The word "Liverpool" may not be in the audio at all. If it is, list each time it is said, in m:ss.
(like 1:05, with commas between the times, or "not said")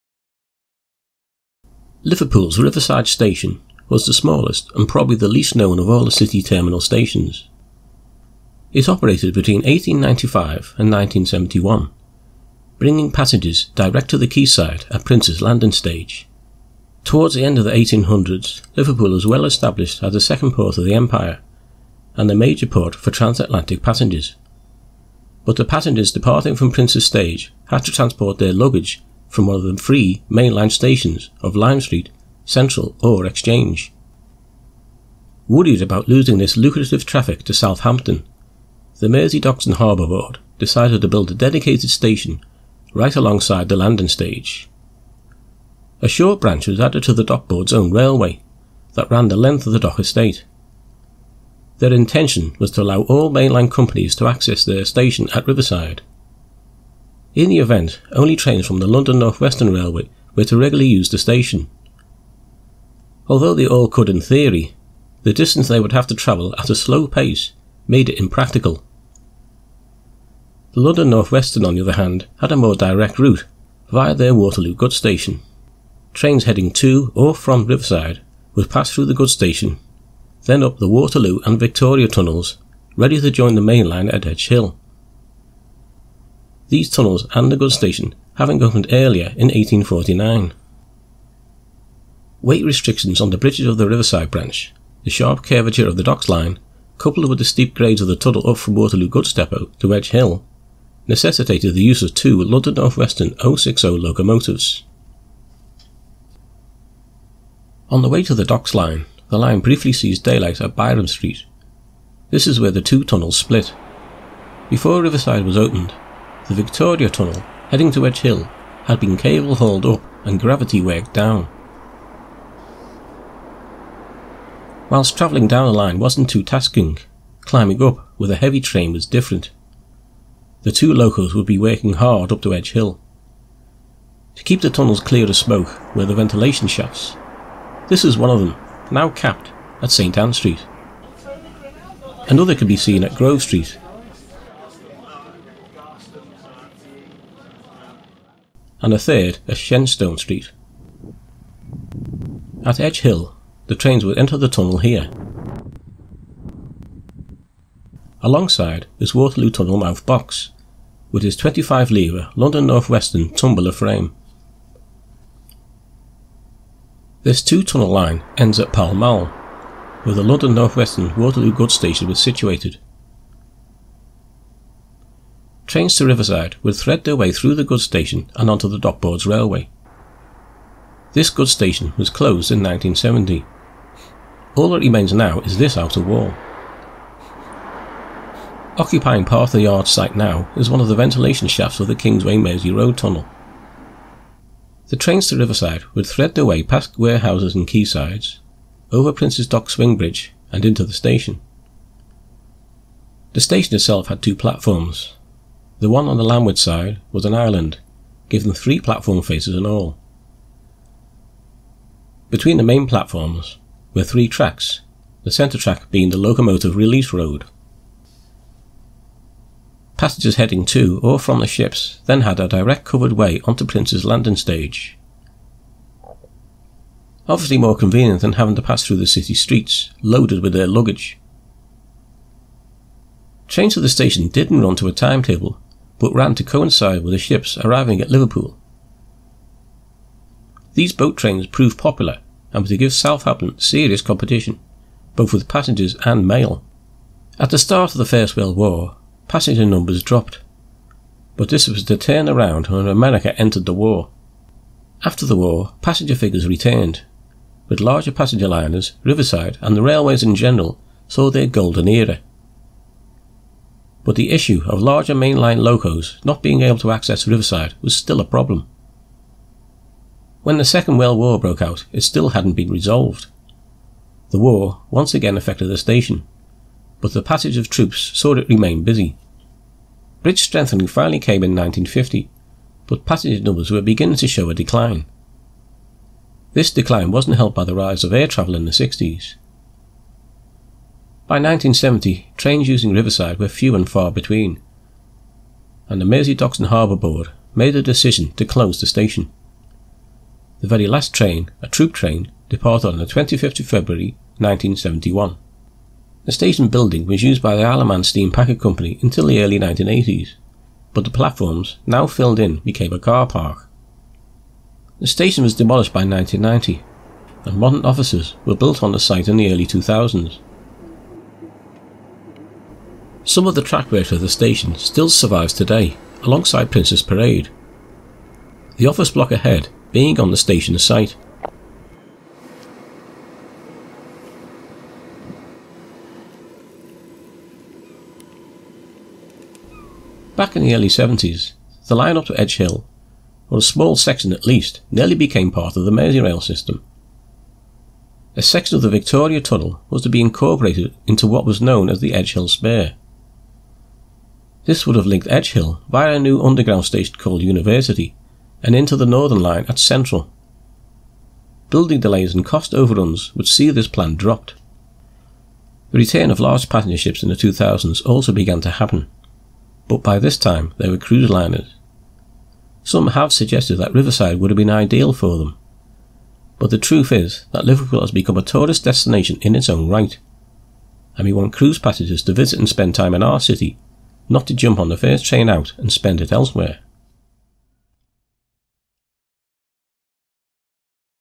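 0:02, 0:18, 3:58, 6:17.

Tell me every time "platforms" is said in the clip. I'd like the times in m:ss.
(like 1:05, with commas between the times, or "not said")
3:24, 3:28, 3:32, 5:11.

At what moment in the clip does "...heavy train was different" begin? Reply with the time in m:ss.
2:08.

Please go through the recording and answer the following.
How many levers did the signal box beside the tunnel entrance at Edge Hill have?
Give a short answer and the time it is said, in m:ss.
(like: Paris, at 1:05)
25, at 2:41.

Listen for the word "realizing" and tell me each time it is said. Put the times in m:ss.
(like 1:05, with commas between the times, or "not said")
not said.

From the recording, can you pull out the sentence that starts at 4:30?
When the Second World War broke out, it still hadn't been resolved.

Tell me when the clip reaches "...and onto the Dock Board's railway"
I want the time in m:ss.
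2:58.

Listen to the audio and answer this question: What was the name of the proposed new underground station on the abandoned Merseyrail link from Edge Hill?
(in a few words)
University.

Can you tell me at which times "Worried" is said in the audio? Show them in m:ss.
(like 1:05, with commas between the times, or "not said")
0:35.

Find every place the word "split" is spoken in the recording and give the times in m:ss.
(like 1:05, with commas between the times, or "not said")
1:53.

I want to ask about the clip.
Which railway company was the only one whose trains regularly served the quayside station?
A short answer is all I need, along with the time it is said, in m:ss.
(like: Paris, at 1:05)
London North Western Railway, at 0:58.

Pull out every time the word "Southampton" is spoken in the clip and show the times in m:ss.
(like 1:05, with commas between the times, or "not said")
0:37, 4:02.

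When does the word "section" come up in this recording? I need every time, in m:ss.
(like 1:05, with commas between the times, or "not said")
5:43, 5:48.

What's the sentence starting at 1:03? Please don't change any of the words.
Although they all could in theory, the distance they would have to travel at a slow pace made it impractical.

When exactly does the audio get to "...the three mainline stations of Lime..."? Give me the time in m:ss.
0:29.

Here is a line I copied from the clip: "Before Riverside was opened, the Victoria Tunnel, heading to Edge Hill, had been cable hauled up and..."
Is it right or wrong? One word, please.
right.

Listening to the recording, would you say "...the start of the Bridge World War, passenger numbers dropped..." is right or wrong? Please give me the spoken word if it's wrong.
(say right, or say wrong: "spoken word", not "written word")
wrong: "First", not "Bridge".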